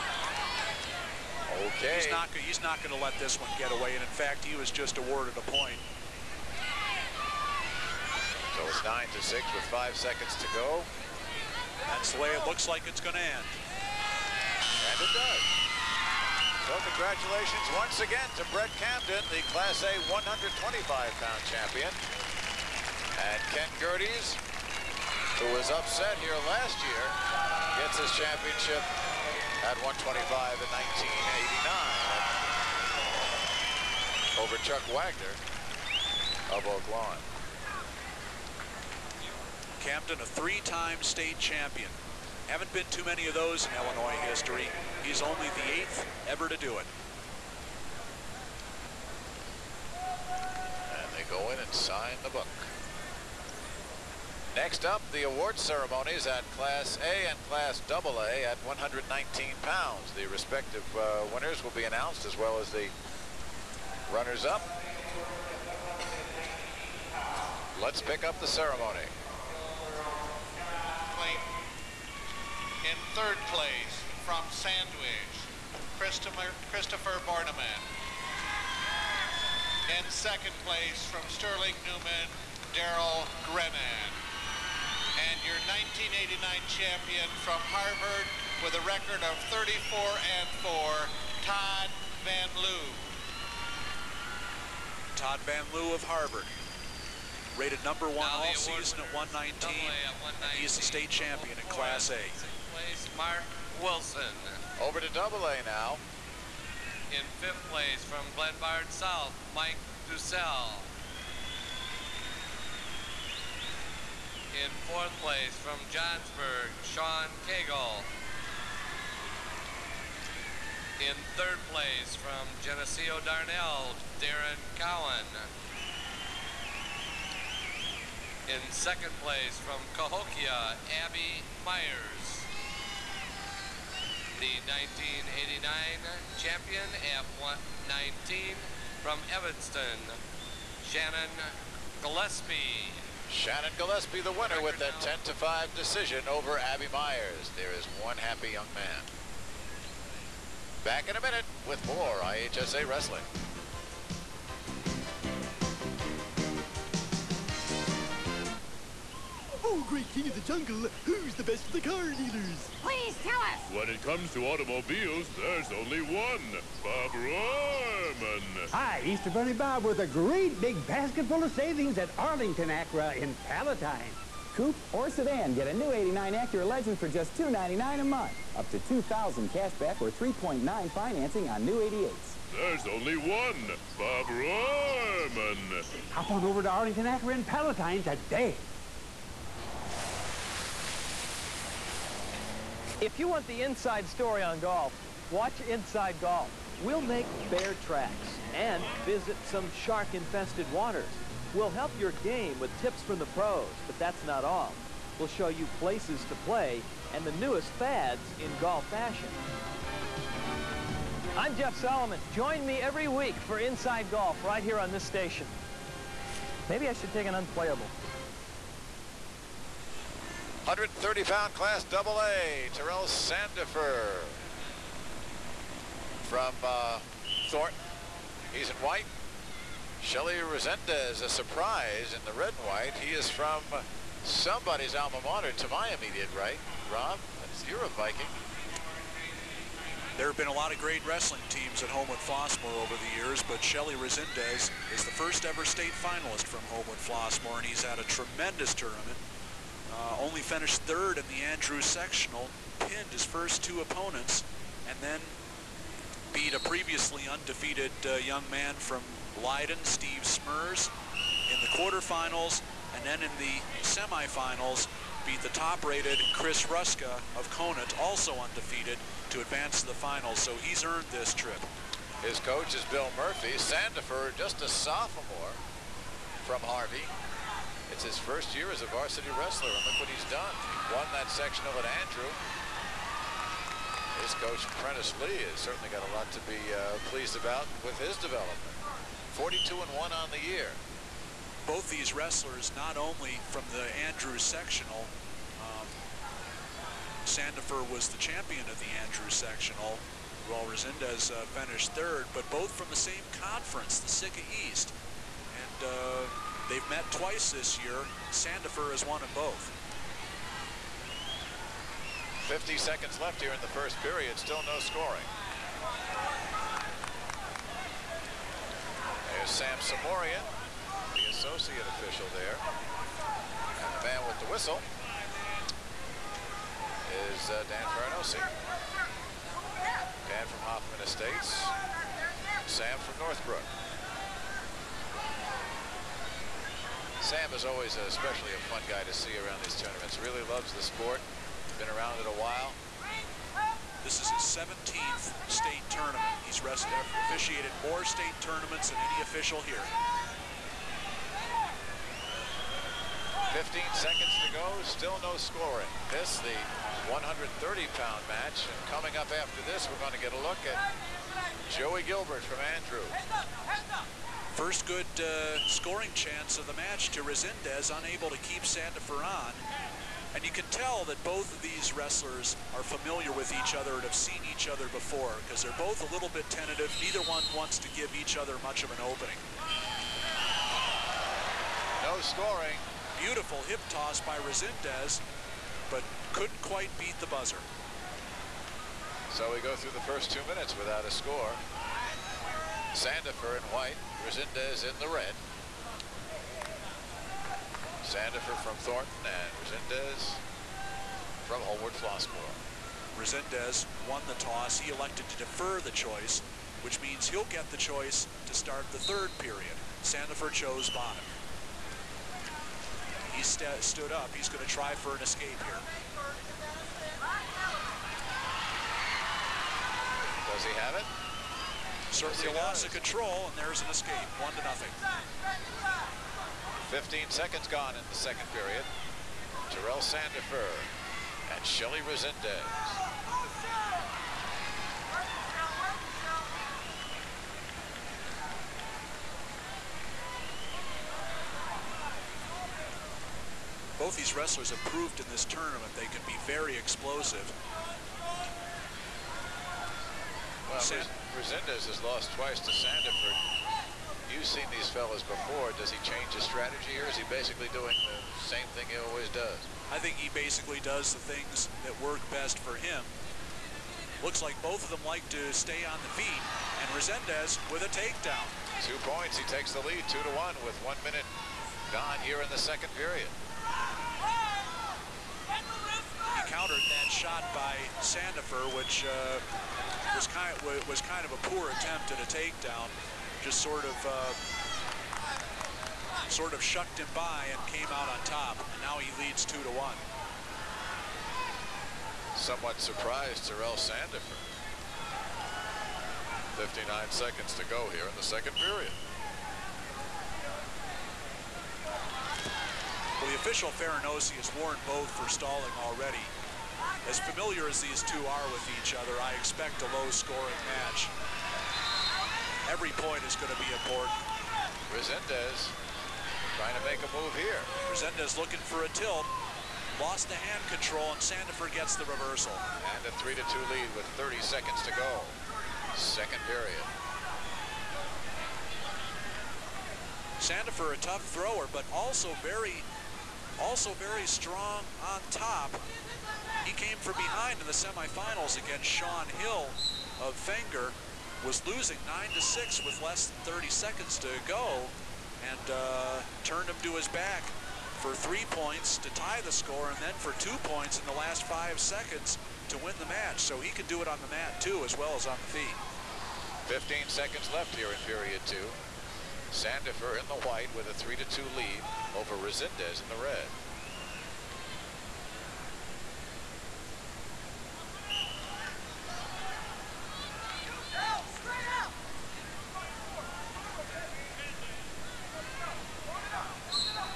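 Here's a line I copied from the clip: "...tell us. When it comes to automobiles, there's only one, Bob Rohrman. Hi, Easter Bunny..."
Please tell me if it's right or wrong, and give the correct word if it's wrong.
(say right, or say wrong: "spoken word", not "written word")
right.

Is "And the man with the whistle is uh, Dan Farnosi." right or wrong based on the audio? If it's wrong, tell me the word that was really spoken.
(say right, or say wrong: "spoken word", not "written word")
right.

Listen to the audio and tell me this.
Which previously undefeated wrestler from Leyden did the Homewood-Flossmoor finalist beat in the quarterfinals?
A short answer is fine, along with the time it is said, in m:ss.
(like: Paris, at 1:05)
Steve Smurs, at 4:19.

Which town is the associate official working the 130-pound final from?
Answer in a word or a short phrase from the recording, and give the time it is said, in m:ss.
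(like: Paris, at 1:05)
Northbrook, at 5:33.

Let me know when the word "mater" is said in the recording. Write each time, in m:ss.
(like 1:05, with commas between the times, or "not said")
3:55.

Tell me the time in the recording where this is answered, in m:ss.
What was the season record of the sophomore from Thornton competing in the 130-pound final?
4:49.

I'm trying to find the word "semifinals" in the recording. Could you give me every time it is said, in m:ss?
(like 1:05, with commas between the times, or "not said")
4:23, 8:57.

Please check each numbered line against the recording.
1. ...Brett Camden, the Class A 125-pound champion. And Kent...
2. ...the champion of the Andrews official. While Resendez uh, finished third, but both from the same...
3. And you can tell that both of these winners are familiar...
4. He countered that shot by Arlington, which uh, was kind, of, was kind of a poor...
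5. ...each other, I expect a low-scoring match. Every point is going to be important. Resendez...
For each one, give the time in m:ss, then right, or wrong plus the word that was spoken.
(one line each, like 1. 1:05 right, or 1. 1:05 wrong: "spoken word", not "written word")
1. 0:18 right
2. 4:58 wrong: "sectional", not "official"
3. 6:10 wrong: "wrestlers", not "winners"
4. 7:55 wrong: "Sandifer", not "Arlington"
5. 8:28 right.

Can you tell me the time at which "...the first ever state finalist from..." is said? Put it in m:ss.
4:05.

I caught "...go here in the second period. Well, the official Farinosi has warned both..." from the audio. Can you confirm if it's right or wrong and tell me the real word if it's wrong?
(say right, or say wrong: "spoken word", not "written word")
right.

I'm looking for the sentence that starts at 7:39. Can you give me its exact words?
I think he basically does the things that work best for him.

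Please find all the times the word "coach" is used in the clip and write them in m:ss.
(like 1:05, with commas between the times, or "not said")
4:32, 4:44.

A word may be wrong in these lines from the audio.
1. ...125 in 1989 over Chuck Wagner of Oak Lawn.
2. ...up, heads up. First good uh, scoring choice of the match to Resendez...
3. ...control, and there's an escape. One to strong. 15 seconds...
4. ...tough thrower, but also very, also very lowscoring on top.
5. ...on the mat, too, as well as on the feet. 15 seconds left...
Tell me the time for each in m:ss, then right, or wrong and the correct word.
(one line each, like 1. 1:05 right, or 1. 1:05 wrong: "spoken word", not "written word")
1. 0:29 right
2. 6:03 wrong: "chance", not "choice"
3. 7:02 wrong: "nothing", not "strong"
4. 8:50 wrong: "strong", not "lowscoring"
5. 9:14 right.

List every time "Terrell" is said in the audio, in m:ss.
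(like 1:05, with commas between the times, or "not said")
3:42, 7:09, 8:13.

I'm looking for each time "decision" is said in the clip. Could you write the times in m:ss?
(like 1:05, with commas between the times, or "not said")
2:25.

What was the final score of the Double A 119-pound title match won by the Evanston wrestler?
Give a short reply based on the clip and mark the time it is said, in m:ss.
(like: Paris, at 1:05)
10 to 5, at 2:25.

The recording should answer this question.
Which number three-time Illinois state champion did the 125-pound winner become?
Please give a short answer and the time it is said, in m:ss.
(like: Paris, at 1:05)
8th, at 0:45.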